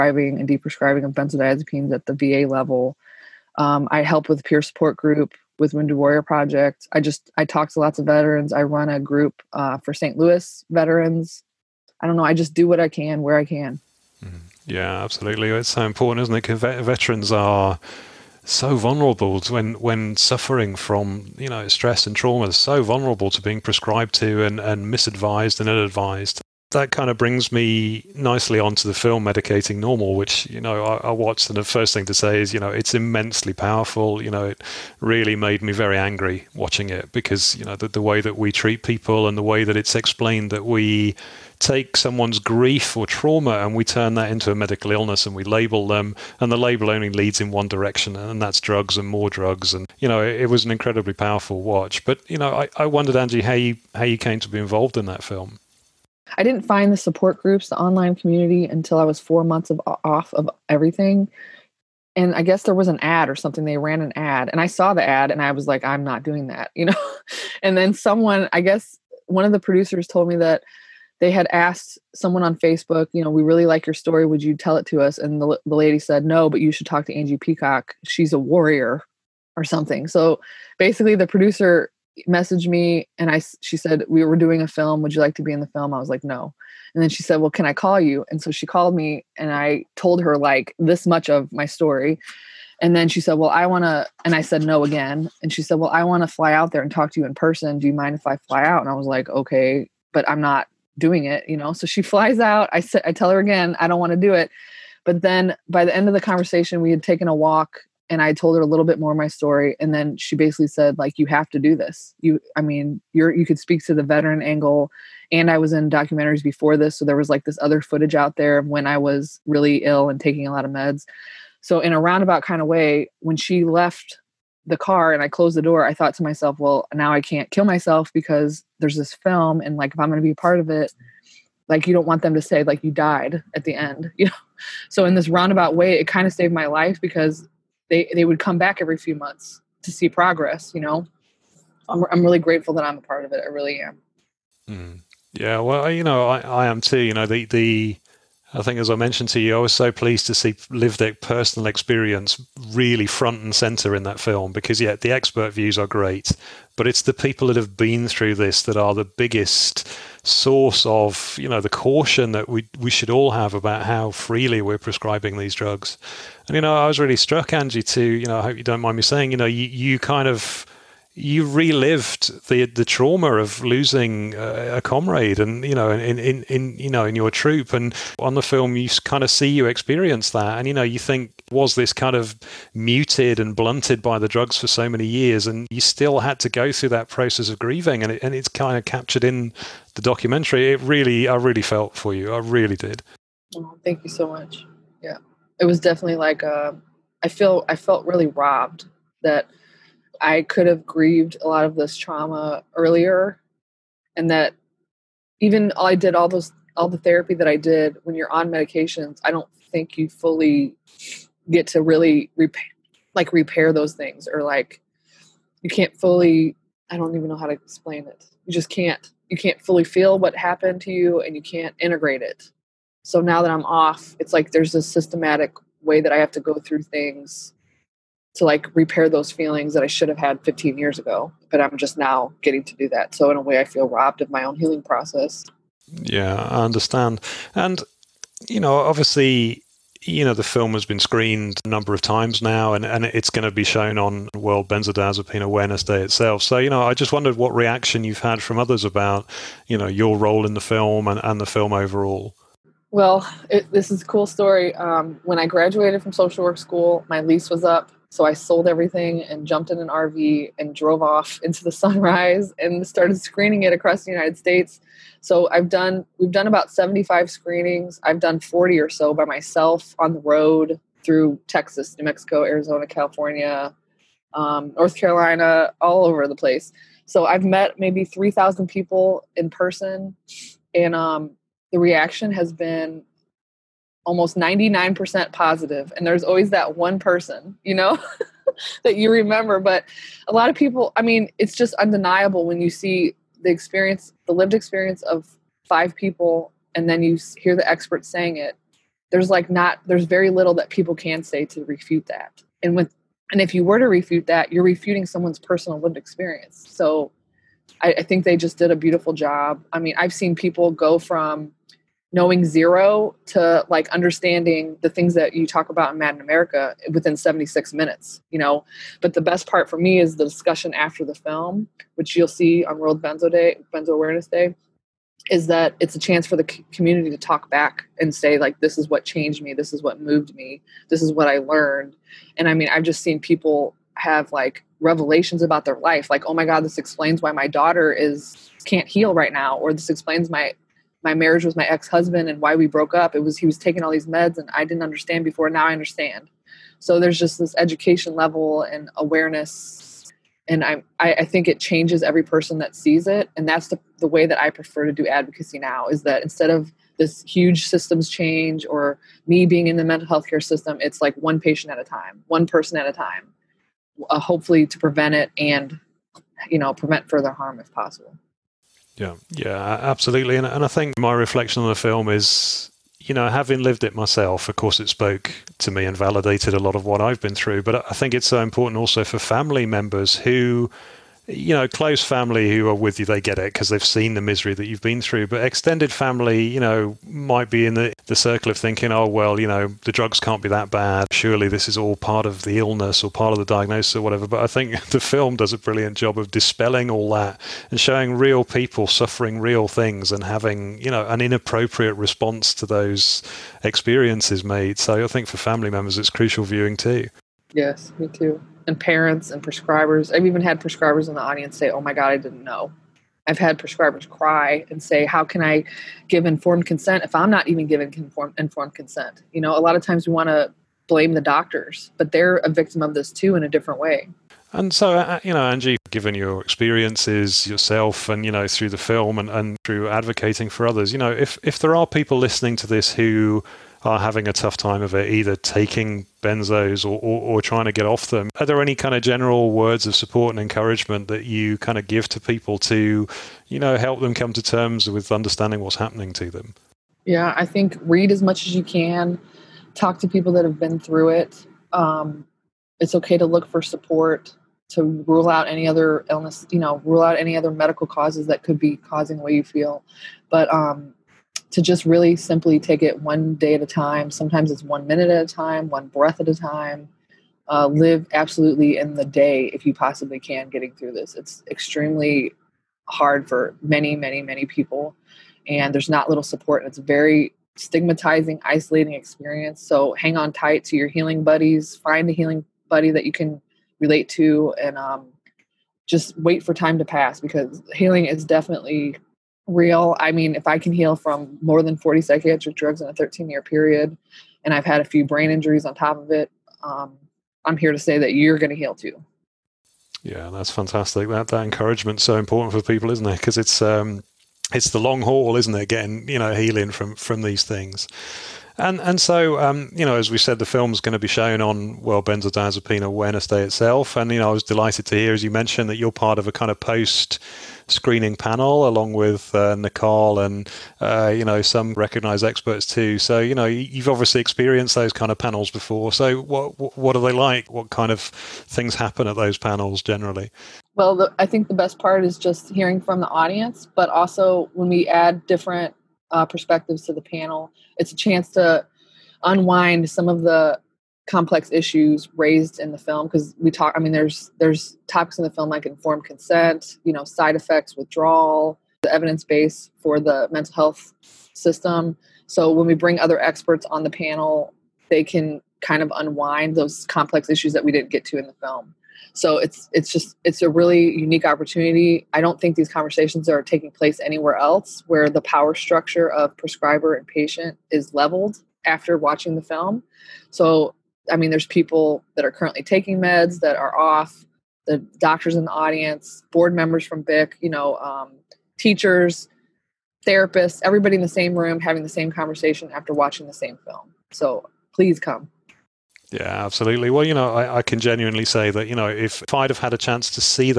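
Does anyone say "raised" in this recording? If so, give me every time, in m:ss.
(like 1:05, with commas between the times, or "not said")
9:02.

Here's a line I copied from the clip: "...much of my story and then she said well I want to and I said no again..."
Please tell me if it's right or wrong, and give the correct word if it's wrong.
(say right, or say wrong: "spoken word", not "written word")
right.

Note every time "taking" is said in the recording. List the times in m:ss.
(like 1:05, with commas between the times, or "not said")
2:00, 5:43, 7:15, 9:23, 9:32.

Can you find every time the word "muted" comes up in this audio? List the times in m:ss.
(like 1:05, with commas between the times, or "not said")
3:02.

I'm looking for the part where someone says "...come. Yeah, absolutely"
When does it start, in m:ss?
9:44.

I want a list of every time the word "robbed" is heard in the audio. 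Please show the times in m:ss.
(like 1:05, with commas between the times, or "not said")
3:18, 3:53.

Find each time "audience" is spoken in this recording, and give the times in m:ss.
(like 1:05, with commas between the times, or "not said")
6:51, 8:53, 9:35.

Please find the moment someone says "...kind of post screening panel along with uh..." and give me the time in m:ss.
8:36.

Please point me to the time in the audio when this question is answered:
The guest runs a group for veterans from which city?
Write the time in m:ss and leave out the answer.
0:09.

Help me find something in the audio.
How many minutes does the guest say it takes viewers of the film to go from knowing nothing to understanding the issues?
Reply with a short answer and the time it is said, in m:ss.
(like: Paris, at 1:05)
76, at 5:17.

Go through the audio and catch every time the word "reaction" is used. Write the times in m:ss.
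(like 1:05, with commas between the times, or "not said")
4:07, 4:41.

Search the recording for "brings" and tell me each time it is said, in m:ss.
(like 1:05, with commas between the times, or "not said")
0:27, 9:12.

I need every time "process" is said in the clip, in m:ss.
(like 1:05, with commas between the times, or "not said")
3:07, 3:54.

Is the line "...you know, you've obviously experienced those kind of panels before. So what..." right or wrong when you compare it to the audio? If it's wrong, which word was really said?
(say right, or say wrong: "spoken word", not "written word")
right.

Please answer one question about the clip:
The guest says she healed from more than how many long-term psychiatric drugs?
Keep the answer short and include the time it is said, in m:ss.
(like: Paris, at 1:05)
40, at 8:11.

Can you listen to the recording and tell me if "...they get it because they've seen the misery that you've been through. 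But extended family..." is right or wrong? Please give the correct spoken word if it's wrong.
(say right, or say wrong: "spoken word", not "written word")
right.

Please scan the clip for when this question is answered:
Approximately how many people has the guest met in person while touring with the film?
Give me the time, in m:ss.
4:38.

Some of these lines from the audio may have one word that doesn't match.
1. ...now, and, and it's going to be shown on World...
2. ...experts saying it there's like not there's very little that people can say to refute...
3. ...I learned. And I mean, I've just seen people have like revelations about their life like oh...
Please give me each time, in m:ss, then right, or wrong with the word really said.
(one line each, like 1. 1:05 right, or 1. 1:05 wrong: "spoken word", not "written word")
1. 4:02 right
2. 4:57 right
3. 5:31 right.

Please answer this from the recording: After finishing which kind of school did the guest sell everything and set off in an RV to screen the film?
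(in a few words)
social work school.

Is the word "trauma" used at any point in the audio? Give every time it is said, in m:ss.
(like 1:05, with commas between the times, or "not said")
0:22, 0:43, 2:52, 3:21.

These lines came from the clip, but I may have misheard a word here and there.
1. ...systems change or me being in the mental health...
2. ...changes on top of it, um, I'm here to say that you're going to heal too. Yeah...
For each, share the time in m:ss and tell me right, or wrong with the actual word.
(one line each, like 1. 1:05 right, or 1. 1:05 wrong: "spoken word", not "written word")
1. 5:57 right
2. 8:15 wrong: "injuries", not "changes".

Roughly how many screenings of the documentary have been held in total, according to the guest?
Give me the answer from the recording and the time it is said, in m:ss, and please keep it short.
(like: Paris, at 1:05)
75, at 4:26.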